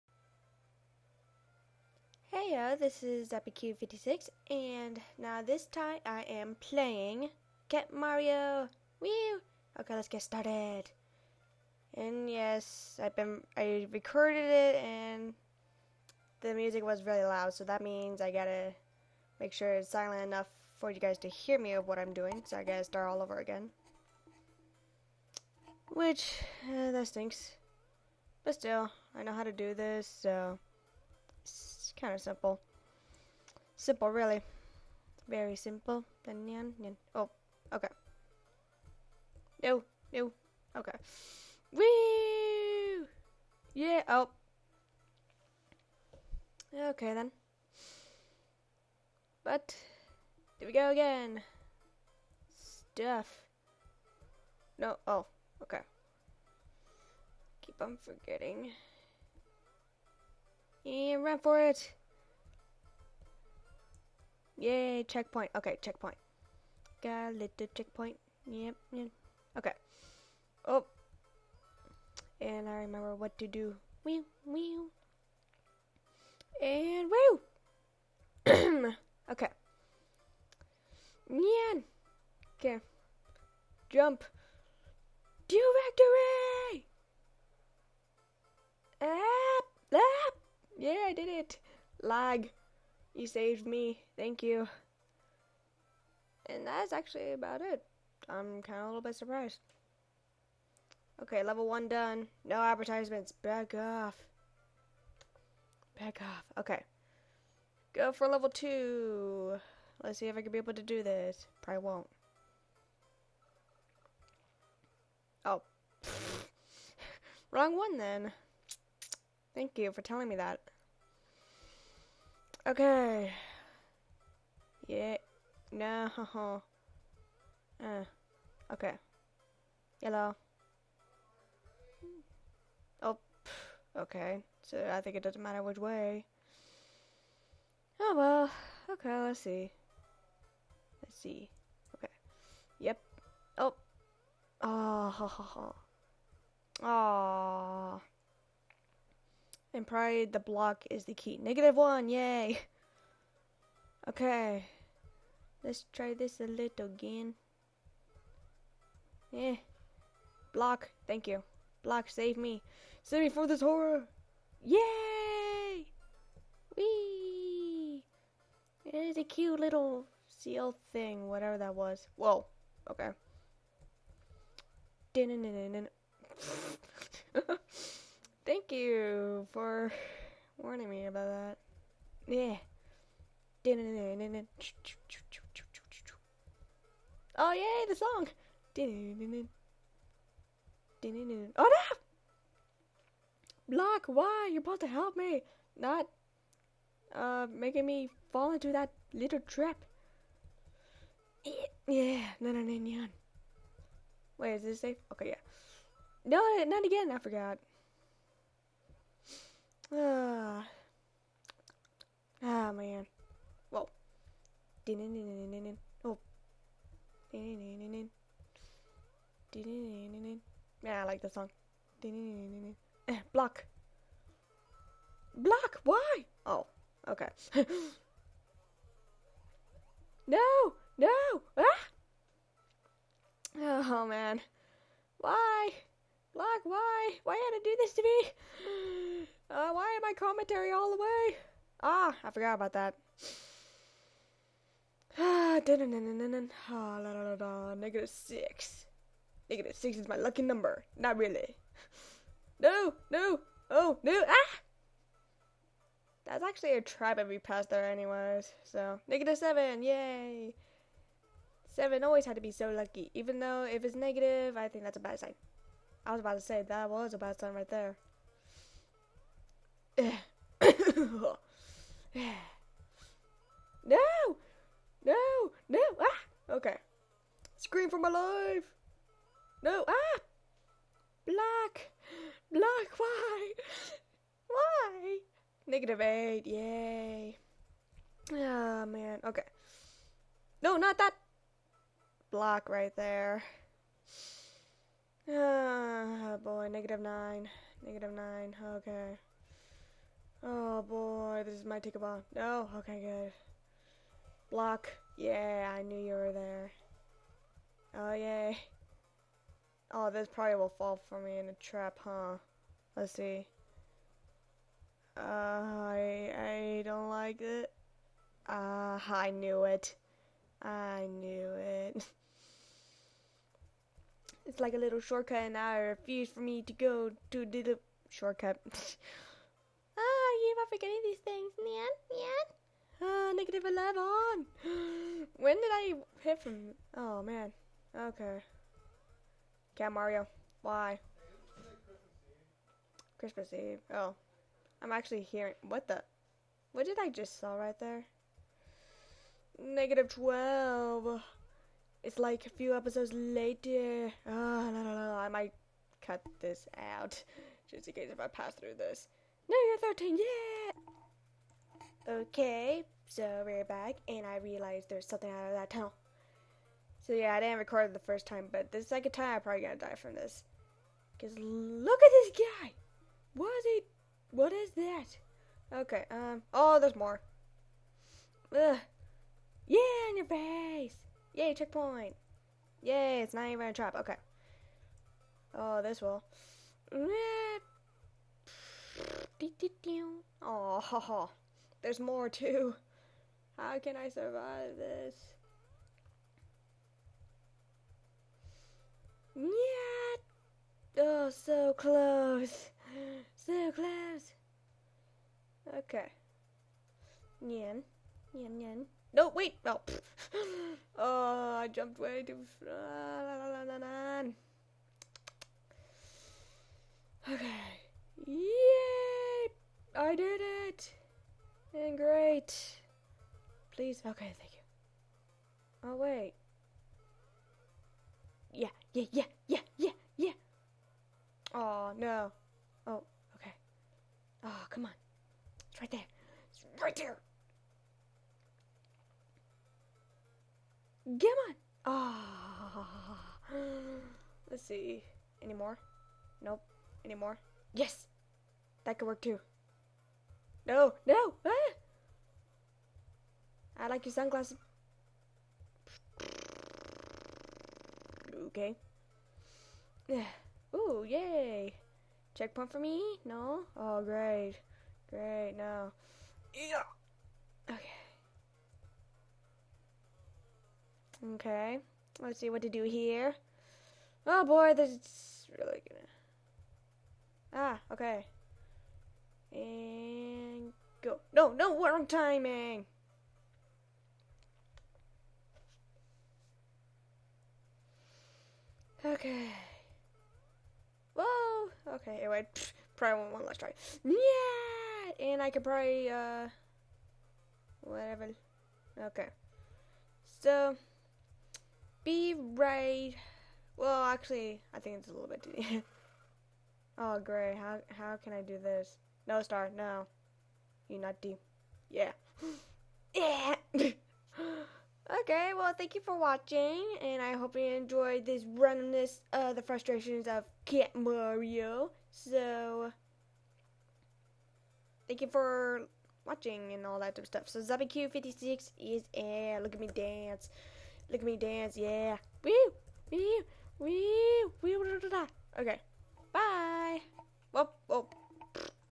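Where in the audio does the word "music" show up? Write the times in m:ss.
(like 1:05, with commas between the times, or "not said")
0:16.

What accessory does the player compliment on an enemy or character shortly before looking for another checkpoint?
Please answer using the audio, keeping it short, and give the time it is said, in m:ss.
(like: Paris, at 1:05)
Sunglasses, at 7:34.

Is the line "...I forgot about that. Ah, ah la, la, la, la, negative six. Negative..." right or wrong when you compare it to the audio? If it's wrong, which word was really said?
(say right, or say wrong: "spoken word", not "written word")
right.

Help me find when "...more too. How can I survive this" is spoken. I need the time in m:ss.
6:31.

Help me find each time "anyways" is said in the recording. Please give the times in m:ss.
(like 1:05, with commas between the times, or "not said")
4:17, 8:12.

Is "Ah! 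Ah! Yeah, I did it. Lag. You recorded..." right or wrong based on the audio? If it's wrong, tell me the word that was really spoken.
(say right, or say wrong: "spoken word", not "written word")
wrong: "saved", not "recorded".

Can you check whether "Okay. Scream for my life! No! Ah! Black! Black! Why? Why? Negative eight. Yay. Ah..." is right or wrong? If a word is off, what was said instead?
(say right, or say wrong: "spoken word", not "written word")
right.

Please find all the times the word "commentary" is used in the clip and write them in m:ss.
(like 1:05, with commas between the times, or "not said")
4:00.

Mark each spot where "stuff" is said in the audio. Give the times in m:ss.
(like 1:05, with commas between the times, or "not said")
0:52, 8:47.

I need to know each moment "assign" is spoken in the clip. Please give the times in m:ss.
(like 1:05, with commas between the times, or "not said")
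not said.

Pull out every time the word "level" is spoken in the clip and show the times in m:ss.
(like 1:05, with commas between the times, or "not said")
1:41, 1:48.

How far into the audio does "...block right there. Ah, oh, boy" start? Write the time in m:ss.
4:52.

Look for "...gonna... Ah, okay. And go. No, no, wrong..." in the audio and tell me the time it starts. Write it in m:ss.
7:55.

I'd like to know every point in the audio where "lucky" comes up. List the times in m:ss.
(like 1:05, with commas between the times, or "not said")
4:10, 4:22.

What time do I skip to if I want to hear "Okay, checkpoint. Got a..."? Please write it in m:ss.
1:05.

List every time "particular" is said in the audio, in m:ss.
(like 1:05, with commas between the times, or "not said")
not said.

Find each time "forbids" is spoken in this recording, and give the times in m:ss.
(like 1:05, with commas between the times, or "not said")
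not said.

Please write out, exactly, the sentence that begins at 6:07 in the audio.
So yeah, I didn't record it the first time, but the second time I'm probably gonna die from this.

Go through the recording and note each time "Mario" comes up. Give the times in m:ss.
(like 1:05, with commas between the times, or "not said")
0:07, 5:39, 8:40.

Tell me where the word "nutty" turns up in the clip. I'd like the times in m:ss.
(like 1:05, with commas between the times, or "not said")
8:31.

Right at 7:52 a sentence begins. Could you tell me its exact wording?
Let's see what to do here.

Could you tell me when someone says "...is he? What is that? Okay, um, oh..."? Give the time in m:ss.
6:13.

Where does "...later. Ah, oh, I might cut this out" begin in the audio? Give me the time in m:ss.
5:53.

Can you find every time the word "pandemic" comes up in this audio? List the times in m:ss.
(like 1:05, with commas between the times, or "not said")
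not said.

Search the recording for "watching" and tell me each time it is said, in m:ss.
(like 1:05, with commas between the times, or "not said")
8:36, 8:46.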